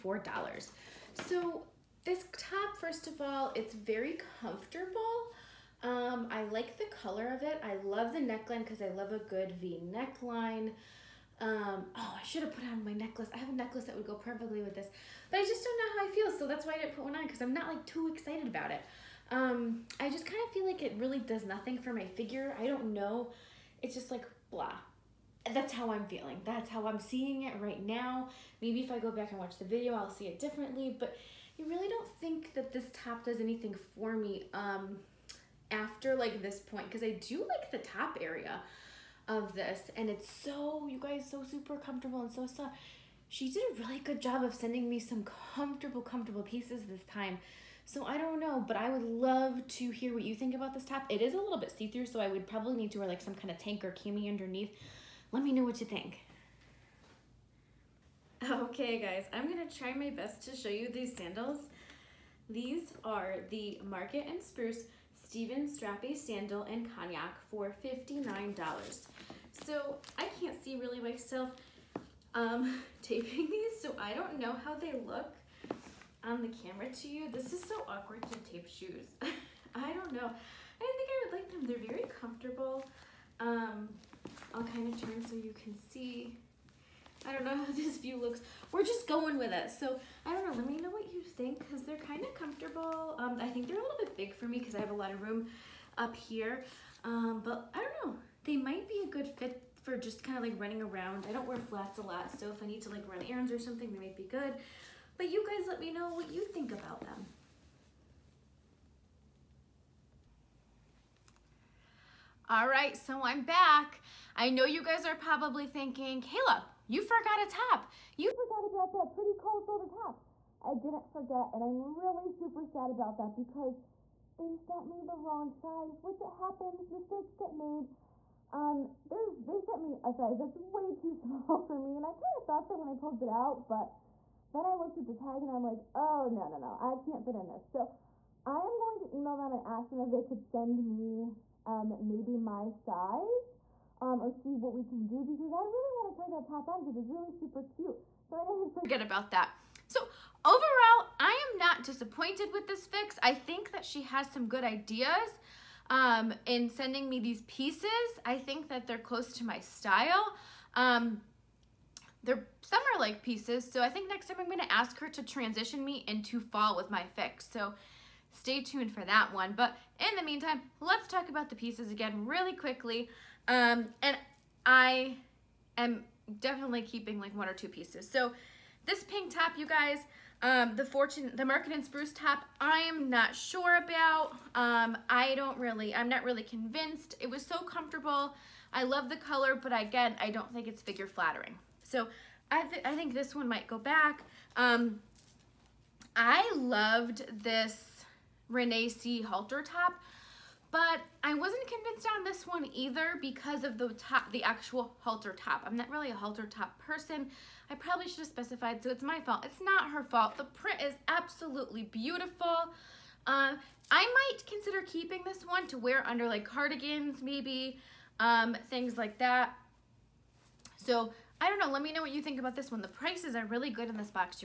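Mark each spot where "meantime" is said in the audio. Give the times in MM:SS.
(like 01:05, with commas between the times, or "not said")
02:50.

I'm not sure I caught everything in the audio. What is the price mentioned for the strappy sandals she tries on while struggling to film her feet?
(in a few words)
$59.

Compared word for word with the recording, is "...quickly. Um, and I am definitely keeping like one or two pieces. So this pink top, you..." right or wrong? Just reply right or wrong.
right.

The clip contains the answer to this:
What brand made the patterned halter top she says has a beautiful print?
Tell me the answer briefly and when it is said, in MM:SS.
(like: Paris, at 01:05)
Renee C, at 03:18.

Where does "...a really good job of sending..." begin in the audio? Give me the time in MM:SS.
00:43.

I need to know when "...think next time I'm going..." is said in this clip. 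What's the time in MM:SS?
02:43.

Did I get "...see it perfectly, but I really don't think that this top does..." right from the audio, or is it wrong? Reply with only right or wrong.
wrong.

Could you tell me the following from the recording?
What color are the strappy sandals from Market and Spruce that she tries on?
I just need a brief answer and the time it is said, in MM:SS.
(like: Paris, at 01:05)
Cognac, at 01:06.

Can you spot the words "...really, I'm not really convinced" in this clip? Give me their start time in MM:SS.
03:05.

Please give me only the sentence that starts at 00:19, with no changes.
Um, I just kind of feel like it really does nothing for my figure.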